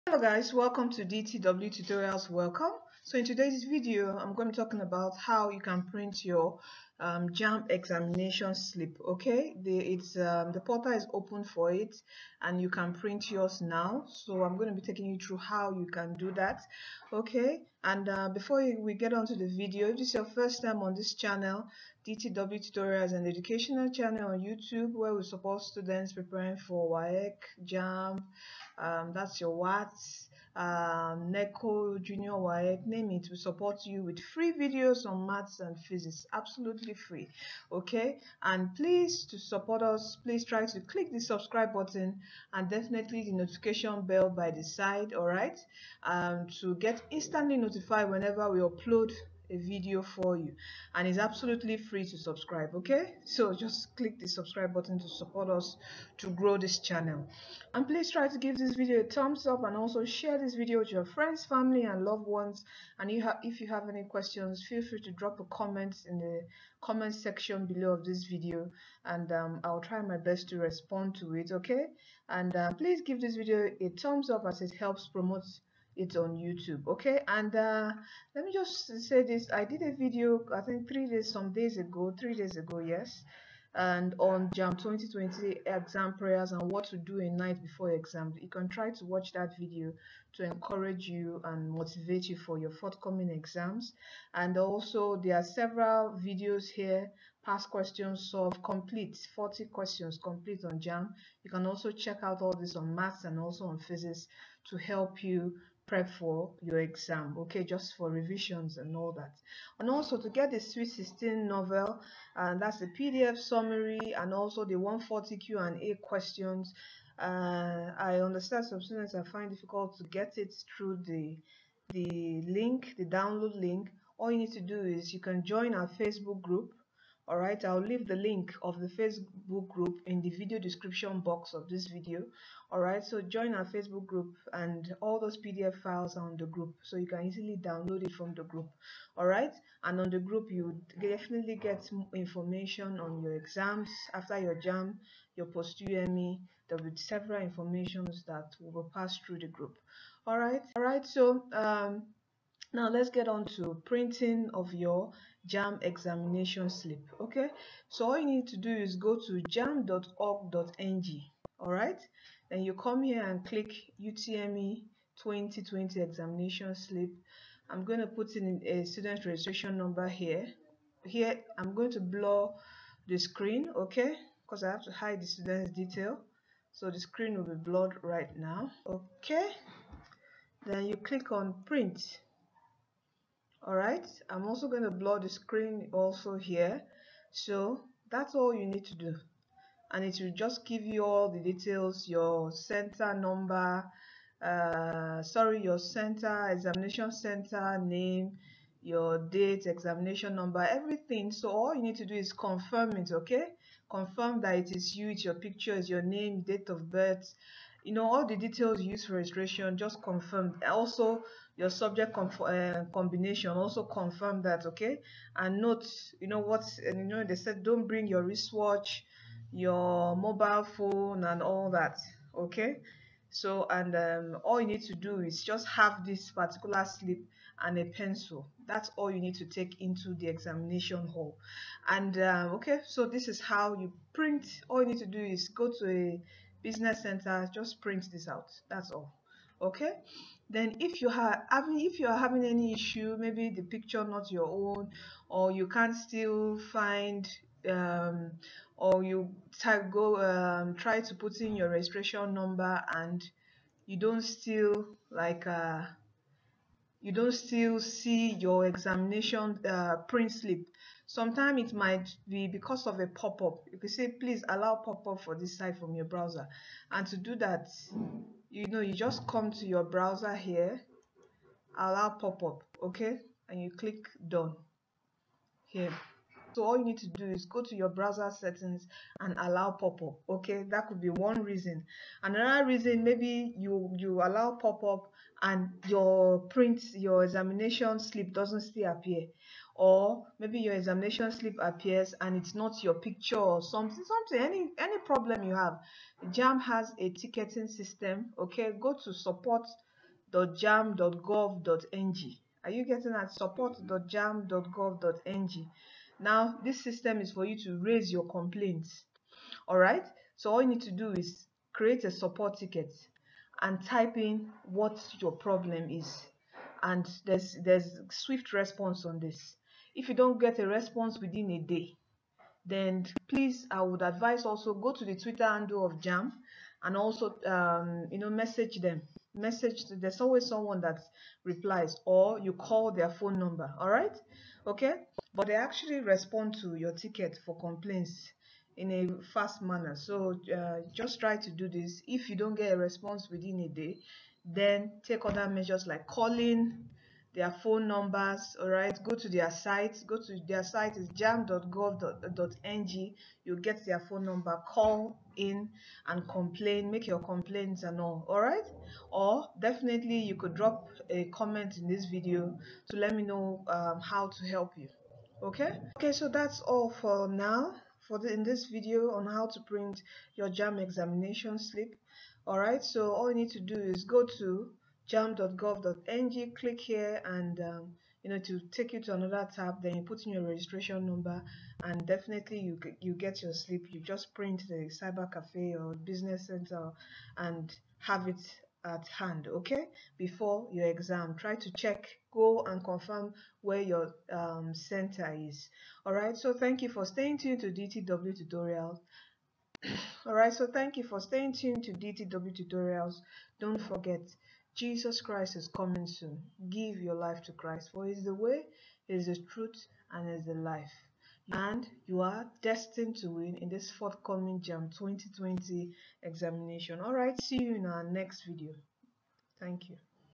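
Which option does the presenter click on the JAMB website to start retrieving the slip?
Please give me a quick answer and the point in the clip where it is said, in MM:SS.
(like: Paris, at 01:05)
UTME 2020 examination slip, at 02:43.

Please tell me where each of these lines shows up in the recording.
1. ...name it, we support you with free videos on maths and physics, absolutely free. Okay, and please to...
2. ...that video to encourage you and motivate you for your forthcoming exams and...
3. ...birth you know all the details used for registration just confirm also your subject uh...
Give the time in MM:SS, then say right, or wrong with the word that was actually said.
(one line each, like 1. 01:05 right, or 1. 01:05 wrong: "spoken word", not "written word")
1. 00:32 right
2. 01:29 right
3. 03:26 right.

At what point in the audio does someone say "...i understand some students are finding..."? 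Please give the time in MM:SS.
01:57.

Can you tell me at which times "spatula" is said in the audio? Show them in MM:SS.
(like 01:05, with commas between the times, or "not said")
not said.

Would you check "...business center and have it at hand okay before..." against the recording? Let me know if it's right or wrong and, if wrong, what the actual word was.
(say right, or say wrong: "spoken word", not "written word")
right.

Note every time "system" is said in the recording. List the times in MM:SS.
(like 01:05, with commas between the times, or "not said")
04:57, 05:06.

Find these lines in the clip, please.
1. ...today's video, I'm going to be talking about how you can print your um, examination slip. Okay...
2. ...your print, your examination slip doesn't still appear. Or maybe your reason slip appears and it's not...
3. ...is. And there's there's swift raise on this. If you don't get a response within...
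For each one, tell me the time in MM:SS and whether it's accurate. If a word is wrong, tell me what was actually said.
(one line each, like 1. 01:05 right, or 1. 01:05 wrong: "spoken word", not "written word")
1. 00:03 right
2. 04:45 wrong: "examination", not "reason"
3. 05:15 wrong: "response", not "raise".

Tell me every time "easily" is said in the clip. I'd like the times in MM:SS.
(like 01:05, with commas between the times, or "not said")
02:17.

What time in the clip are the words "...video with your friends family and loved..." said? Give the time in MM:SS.
01:00.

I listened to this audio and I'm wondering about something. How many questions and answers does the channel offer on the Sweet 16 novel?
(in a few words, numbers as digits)
140.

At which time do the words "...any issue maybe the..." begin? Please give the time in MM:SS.
04:02.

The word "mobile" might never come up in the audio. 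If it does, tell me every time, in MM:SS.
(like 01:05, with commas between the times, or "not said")
03:40.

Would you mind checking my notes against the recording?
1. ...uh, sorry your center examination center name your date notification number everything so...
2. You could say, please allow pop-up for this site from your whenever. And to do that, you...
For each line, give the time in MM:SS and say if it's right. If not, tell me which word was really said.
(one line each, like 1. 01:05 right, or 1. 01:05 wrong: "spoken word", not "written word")
1. 03:14 wrong: "examination", not "notification"
2. 04:23 wrong: "browser", not "whenever".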